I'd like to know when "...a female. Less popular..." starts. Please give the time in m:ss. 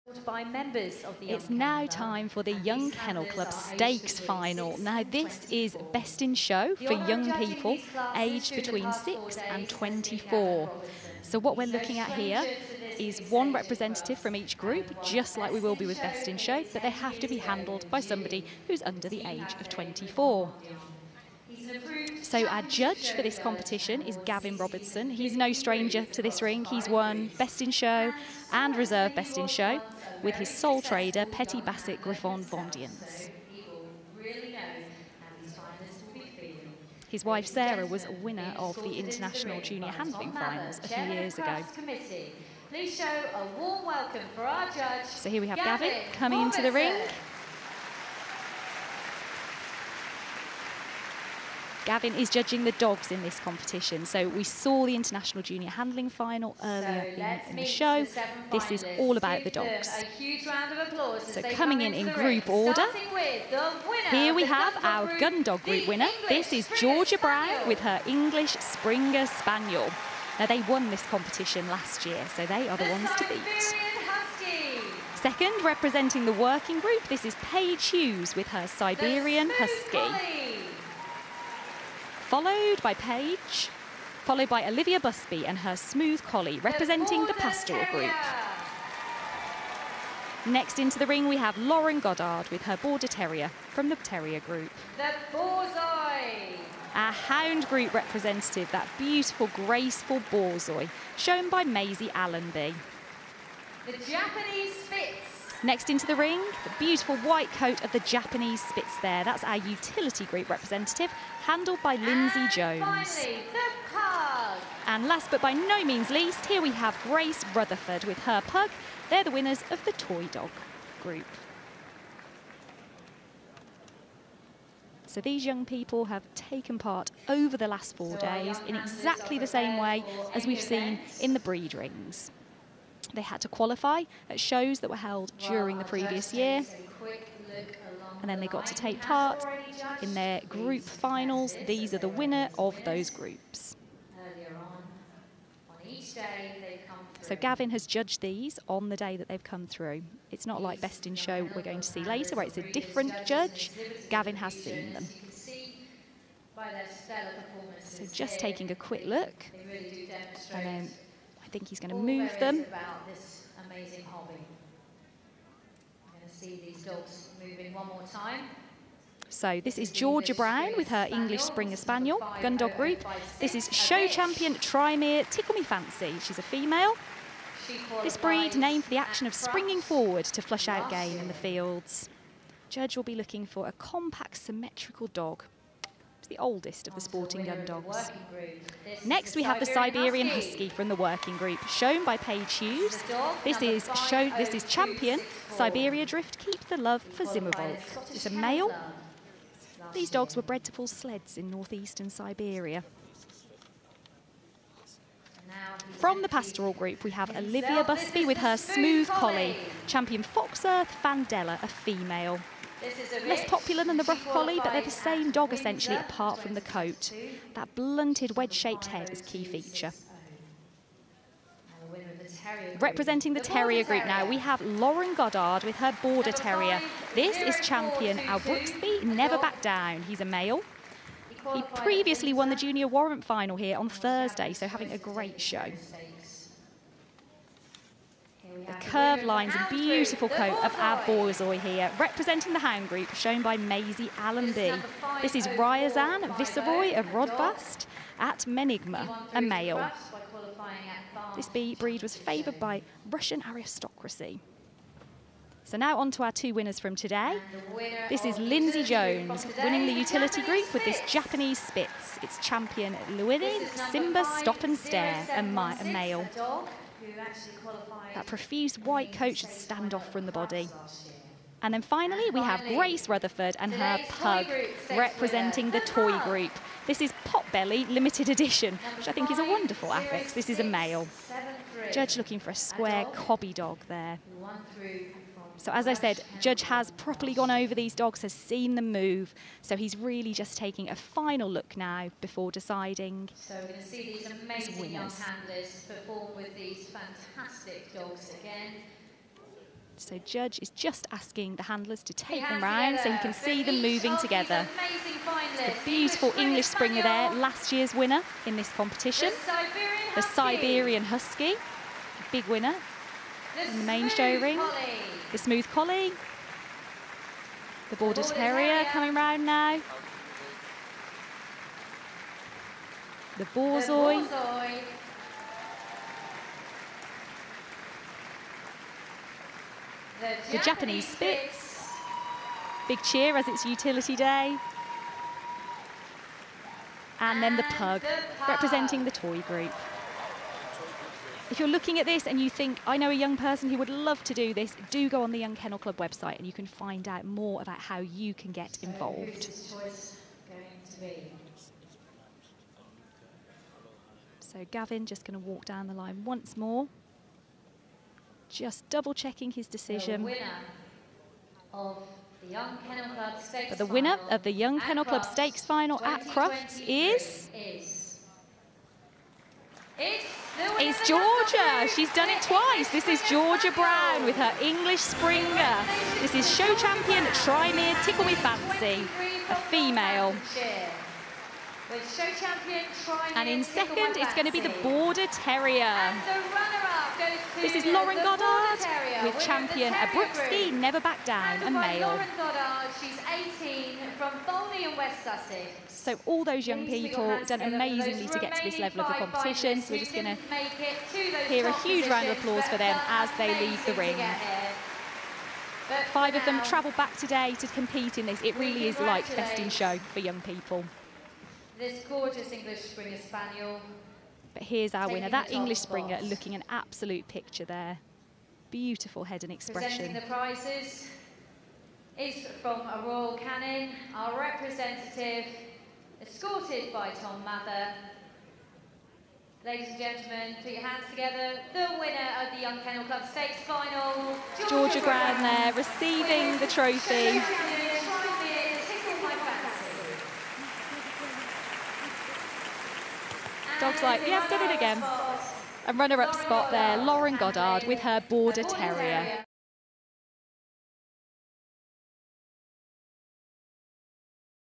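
3:31.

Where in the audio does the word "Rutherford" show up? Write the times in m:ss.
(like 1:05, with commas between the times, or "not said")
1:57, 4:33.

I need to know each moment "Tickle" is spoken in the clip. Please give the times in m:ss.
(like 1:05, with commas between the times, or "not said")
2:55, 6:18.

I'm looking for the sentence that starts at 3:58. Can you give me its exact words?
The curved lines and beautiful coat of our Borzoi here, representing the hound group, shown by Maisie Allenby.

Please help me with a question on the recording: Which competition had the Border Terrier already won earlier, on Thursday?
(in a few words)
Junior warrant final.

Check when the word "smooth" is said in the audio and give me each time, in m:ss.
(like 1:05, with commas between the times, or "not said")
1:25, 3:28, 5:15.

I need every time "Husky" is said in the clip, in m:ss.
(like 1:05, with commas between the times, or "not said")
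1:14, 1:19, 3:10, 5:11.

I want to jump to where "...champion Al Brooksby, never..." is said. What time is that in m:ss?
3:47.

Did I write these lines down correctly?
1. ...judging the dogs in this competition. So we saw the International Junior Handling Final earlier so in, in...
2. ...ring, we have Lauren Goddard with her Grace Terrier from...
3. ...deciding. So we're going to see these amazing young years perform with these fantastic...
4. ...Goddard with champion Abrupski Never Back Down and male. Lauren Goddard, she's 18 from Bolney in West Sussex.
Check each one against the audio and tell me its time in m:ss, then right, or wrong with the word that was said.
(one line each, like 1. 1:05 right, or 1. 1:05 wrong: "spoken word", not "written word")
1. 0:52 right
2. 1:31 wrong: "Border", not "Grace"
3. 4:52 wrong: "handlers", not "years"
4. 6:28 right.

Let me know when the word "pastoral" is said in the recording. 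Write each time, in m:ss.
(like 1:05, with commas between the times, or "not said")
1:27, 3:26.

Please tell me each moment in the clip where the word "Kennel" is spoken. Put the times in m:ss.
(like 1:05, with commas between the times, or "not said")
0:02, 5:45, 6:04, 7:12.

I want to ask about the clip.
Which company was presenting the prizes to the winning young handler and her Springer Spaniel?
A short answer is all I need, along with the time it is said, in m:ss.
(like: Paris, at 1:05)
Royal Canin, at 7:03.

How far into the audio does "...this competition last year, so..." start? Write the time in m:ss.
1:10.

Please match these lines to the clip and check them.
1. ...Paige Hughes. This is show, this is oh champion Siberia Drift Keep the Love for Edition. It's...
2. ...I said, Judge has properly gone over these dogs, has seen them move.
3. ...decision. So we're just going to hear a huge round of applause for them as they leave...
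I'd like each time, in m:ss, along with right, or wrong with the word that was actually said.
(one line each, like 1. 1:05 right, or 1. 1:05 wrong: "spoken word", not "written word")
1. 3:12 wrong: "Zimmerwald", not "Edition"
2. 4:45 right
3. 6:39 wrong: "competition", not "decision".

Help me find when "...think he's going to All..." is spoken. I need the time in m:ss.
2:41.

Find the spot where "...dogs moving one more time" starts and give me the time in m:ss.
2:46.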